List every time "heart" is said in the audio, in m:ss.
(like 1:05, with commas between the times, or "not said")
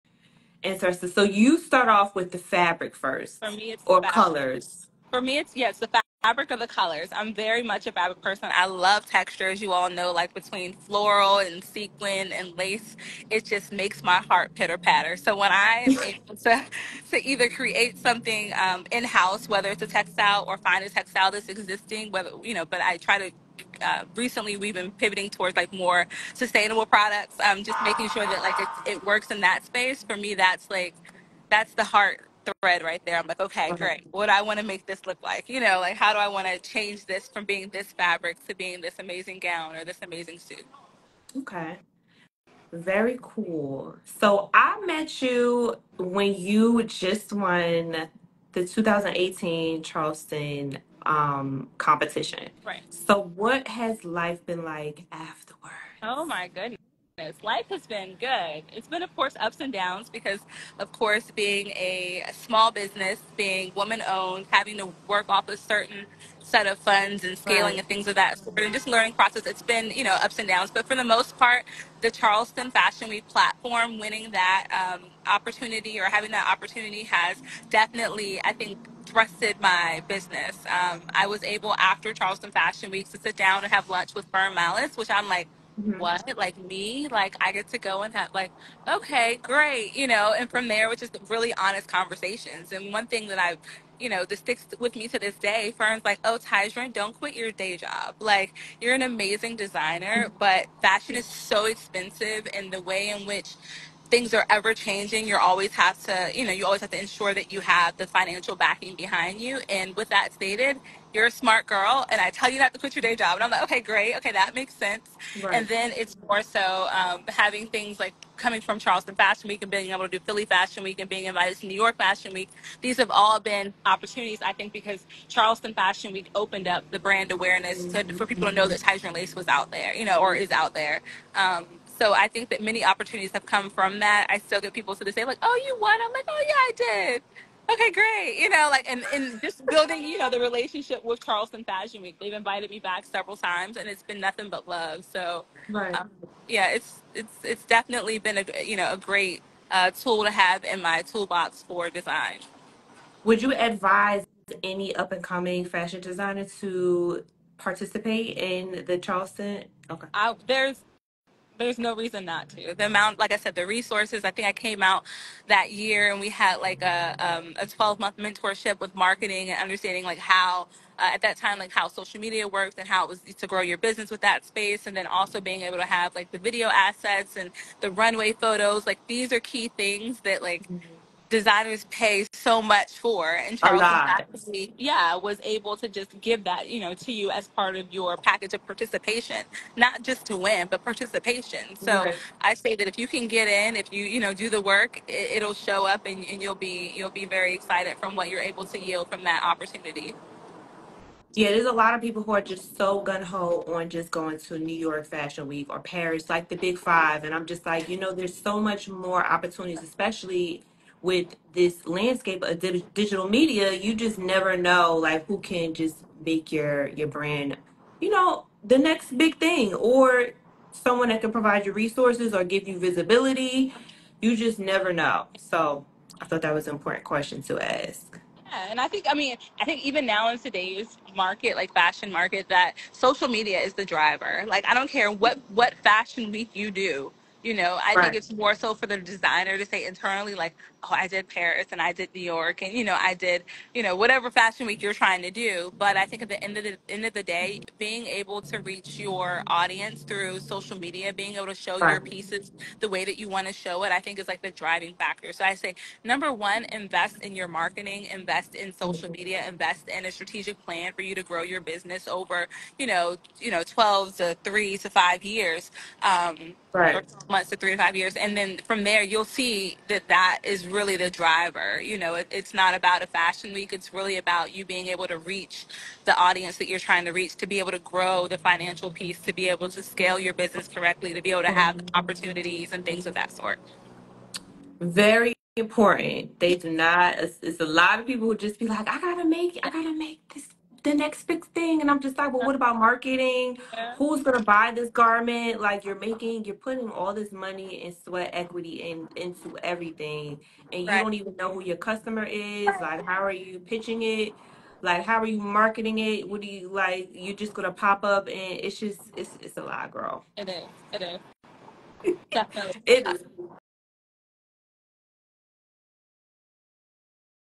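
0:14, 0:31.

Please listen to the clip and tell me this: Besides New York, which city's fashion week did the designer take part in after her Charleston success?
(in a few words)
Philly.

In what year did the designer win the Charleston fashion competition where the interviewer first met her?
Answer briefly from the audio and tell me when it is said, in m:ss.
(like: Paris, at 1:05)
2018, at 0:48.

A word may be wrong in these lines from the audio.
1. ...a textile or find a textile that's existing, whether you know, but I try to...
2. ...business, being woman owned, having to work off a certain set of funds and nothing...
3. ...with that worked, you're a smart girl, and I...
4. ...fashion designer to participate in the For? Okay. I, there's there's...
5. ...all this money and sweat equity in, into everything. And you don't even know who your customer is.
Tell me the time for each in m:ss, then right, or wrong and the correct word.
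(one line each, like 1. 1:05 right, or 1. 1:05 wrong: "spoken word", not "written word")
1. 0:19 right
2. 1:02 wrong: "scaling", not "nothing"
3. 1:49 wrong: "stated", not "worked"
4. 2:35 wrong: "Charleston", not "For"
5. 4:56 right.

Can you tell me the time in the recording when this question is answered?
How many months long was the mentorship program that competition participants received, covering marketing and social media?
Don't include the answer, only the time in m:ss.
2:47.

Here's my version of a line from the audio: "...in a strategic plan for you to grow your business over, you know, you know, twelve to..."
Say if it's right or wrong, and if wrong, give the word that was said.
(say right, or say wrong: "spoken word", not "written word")
right.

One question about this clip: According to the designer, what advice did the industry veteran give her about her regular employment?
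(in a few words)
Don't quit your day job.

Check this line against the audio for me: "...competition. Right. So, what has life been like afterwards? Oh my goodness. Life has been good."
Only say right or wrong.
right.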